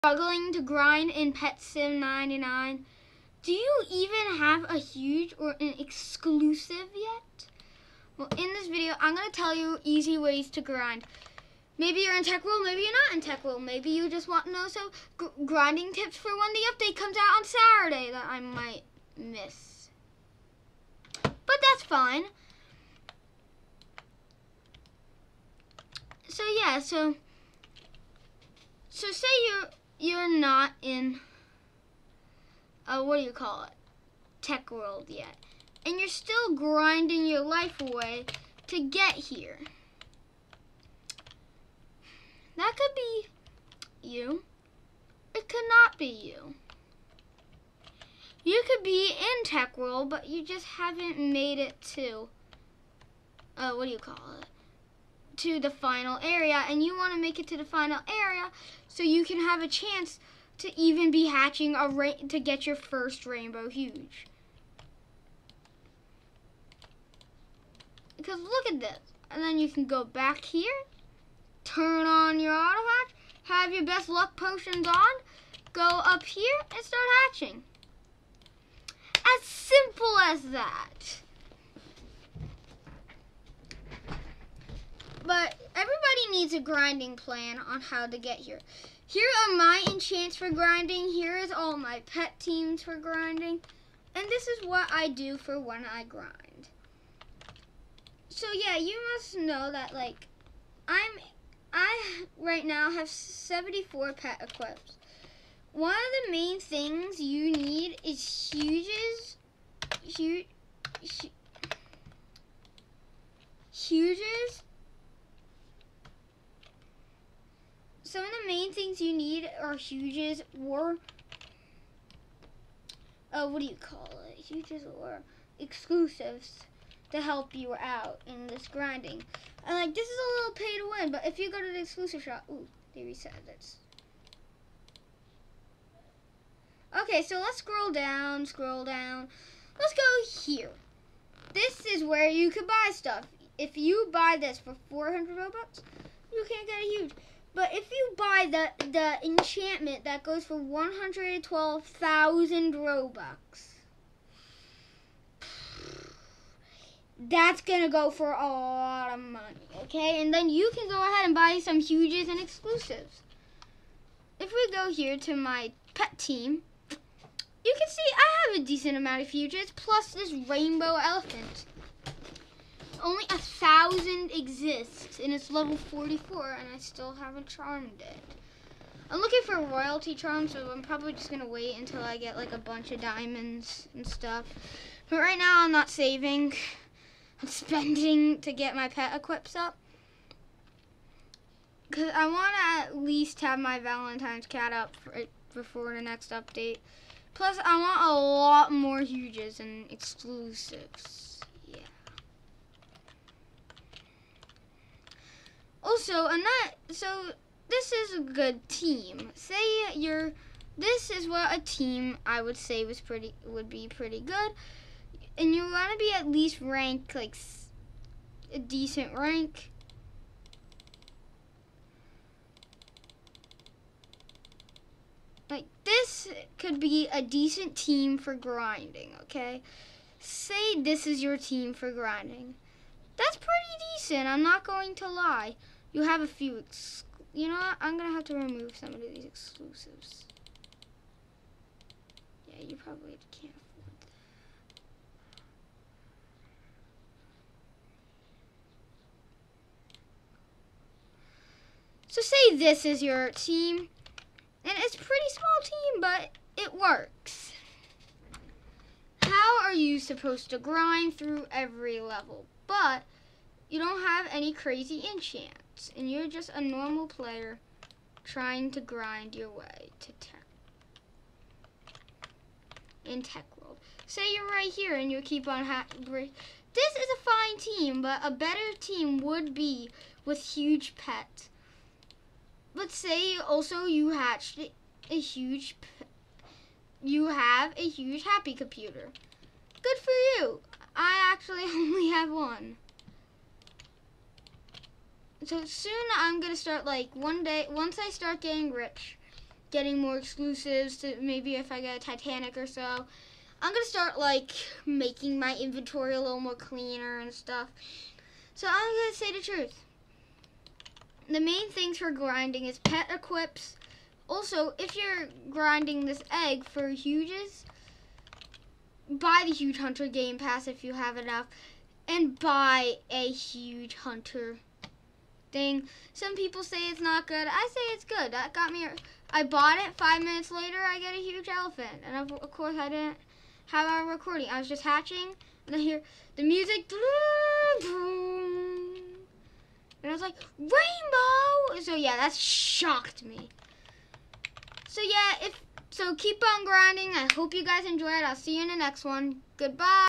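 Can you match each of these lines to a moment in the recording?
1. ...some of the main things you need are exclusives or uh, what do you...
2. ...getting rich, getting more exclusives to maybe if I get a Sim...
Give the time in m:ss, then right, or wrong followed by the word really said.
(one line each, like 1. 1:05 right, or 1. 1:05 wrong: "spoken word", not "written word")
1. 1:58 wrong: "huges", not "exclusives"
2. 4:58 wrong: "Titanic", not "Sim".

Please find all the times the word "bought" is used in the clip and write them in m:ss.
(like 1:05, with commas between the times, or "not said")
5:29.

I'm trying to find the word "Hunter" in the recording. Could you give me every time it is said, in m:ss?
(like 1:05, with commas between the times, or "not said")
5:19, 5:23.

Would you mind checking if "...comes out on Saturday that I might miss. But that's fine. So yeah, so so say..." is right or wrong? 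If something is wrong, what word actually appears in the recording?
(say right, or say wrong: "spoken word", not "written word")
right.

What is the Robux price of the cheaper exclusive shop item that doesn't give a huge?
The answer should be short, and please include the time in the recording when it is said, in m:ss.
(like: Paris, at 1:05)
400 Robux, at 2:24.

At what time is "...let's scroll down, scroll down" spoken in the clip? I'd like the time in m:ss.
2:17.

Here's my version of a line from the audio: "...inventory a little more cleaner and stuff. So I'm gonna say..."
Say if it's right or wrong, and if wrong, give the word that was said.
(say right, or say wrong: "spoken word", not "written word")
right.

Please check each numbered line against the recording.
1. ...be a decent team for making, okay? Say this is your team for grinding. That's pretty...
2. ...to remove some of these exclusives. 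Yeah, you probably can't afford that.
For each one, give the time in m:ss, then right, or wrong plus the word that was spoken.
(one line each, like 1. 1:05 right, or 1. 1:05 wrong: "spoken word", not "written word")
1. 3:46 wrong: "grinding", not "making"
2. 3:58 right.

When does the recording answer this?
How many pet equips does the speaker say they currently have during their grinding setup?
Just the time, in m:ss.
1:43.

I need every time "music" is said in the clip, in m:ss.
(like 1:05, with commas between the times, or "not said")
5:36.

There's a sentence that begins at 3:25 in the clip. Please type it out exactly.
Also, and not so this is a good team.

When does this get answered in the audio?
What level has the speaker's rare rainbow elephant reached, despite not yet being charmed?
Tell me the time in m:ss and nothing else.
2:55.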